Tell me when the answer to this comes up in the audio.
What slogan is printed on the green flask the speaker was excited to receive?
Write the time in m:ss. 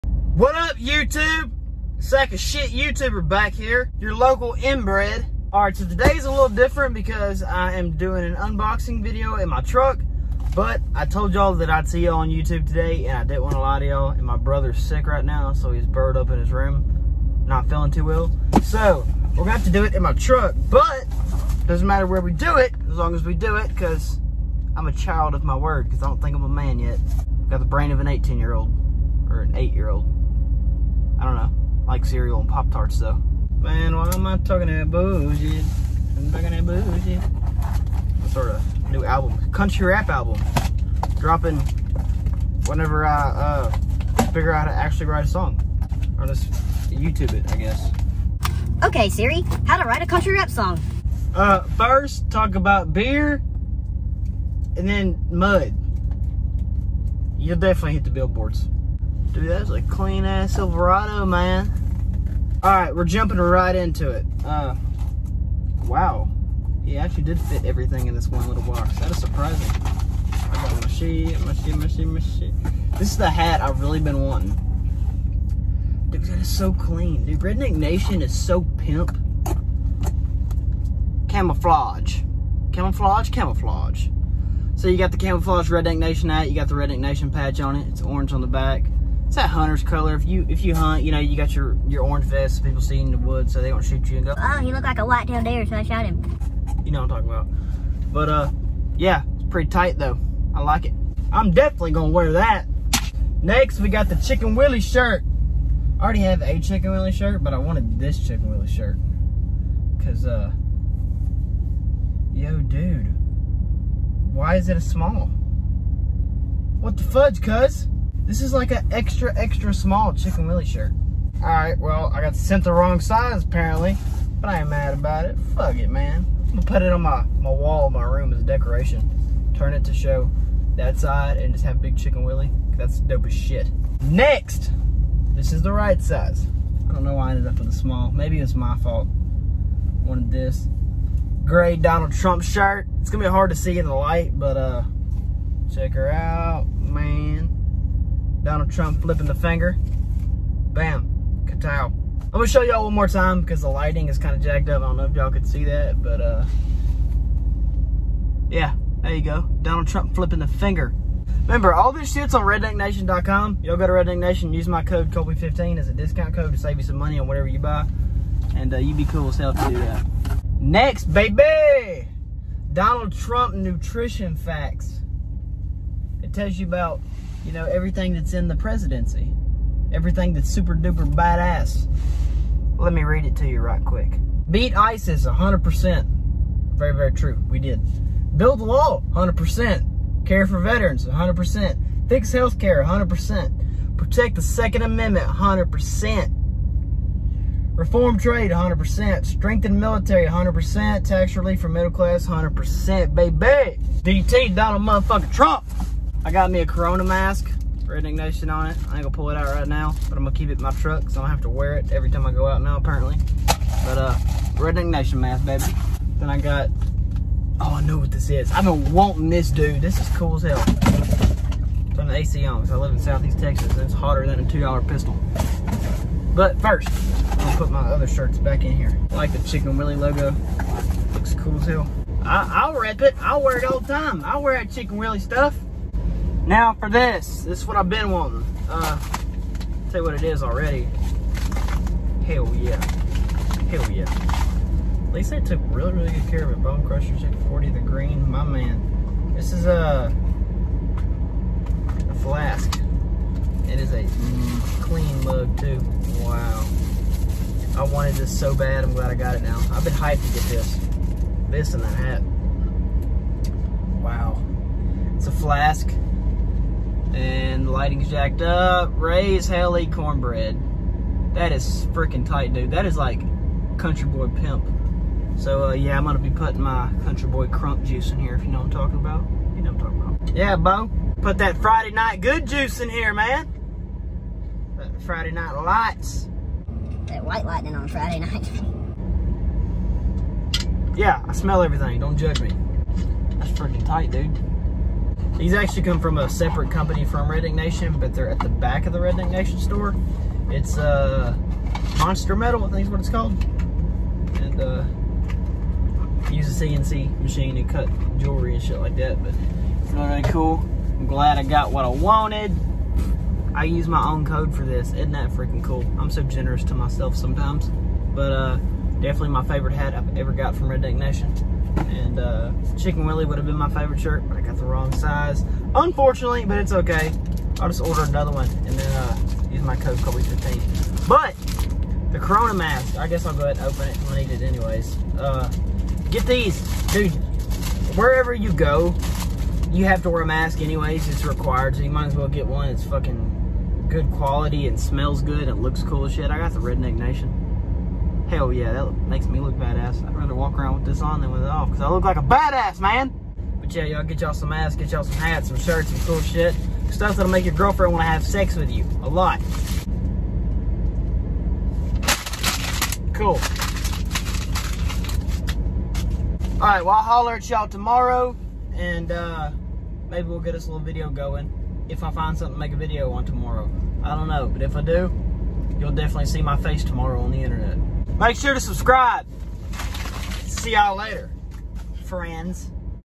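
4:28.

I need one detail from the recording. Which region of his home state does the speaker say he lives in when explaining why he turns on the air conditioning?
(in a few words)
Southeast Texas.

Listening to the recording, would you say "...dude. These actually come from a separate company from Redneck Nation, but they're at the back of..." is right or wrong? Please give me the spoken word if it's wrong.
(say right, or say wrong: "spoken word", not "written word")
right.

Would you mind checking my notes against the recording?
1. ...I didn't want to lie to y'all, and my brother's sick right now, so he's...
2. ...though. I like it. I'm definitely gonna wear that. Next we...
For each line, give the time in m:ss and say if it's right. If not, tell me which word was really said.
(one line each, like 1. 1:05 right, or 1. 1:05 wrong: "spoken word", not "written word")
1. 0:13 right
2. 1:39 right.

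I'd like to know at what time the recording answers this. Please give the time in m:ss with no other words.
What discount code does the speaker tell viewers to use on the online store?
2:45.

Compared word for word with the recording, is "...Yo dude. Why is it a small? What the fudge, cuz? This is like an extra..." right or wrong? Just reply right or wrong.
right.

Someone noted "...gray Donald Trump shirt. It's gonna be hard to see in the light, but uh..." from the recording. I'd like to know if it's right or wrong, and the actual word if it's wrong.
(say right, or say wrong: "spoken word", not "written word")
right.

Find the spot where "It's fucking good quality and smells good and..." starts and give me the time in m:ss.
5:42.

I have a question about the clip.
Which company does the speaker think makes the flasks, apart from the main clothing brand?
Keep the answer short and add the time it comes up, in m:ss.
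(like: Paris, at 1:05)
Monster Metal, at 5:01.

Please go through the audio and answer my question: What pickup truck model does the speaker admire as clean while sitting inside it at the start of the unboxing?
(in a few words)
Silverado.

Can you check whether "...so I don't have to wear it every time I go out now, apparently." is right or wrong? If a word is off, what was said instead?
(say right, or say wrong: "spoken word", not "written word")
right.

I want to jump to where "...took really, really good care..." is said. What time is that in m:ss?
4:05.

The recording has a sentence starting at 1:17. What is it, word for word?
Dude, Redneck Nation is so pimp.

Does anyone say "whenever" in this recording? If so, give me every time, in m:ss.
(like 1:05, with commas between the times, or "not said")
0:42.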